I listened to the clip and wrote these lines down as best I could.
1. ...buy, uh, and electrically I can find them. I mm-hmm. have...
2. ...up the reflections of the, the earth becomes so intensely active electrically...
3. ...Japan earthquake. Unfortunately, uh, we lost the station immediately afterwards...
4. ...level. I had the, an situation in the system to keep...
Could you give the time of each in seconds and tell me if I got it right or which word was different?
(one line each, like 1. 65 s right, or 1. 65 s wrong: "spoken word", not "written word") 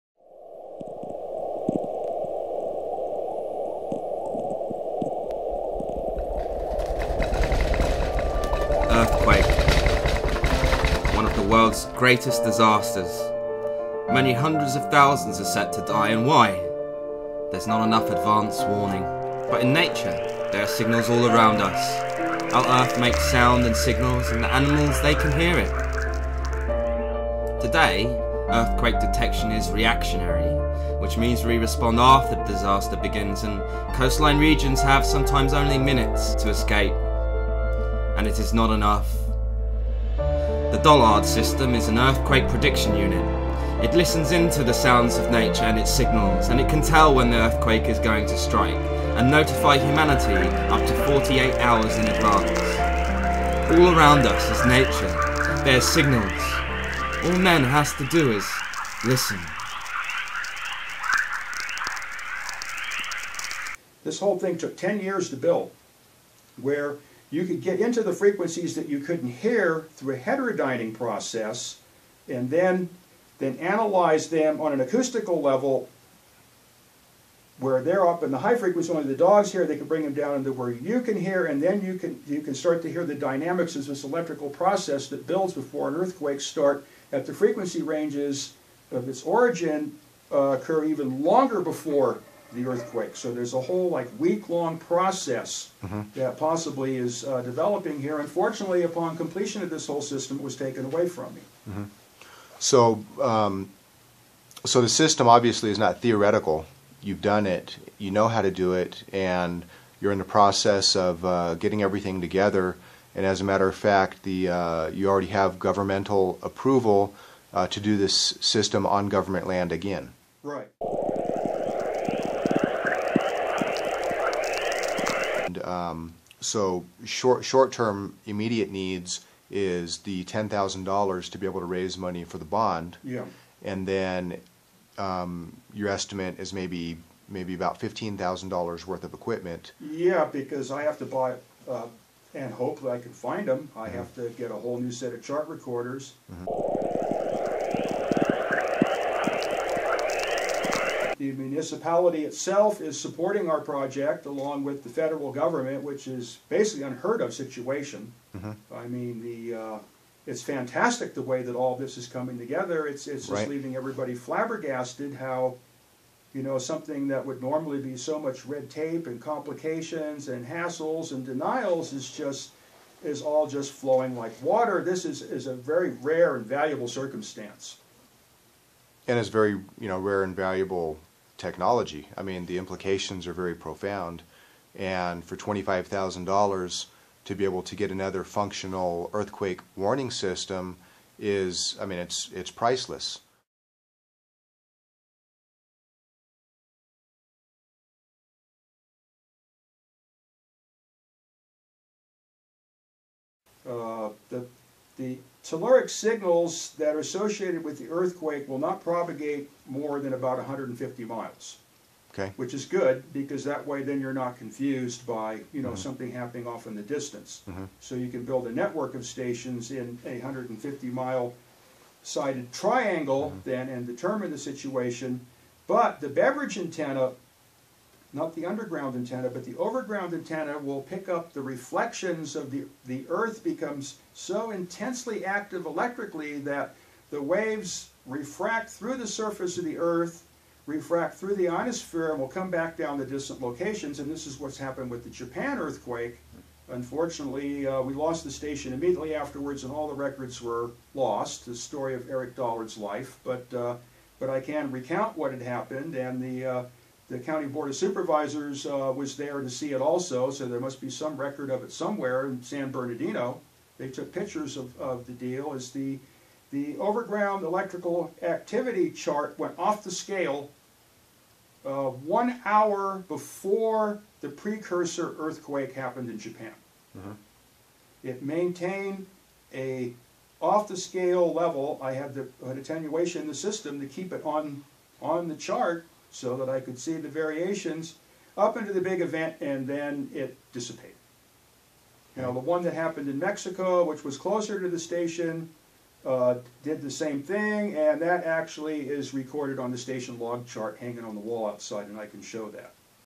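1. 141 s wrong: "hopefully", not "electrically"
2. 231 s right
3. 245 s right
4. 281 s wrong: "attenuation", not "situation".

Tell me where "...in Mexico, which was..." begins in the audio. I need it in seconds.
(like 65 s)
293 s.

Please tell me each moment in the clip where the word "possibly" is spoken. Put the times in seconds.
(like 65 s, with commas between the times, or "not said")
96 s.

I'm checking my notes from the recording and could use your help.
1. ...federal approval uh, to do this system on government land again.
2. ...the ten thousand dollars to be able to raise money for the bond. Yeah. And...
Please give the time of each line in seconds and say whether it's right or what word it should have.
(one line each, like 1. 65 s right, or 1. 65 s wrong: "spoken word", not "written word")
1. 115 s wrong: "governmental", not "federal"
2. 129 s right.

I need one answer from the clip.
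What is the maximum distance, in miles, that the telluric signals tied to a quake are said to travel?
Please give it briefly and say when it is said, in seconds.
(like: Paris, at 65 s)
150 miles, at 210 s.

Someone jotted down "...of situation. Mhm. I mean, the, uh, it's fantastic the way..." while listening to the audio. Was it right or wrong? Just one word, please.
right.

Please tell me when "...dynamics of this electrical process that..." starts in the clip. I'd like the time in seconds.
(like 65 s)
83 s.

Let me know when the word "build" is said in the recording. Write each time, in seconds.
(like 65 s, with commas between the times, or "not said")
65 s, 85 s, 218 s.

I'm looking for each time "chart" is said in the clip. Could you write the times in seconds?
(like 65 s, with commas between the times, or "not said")
145 s, 268 s, 285 s, 300 s.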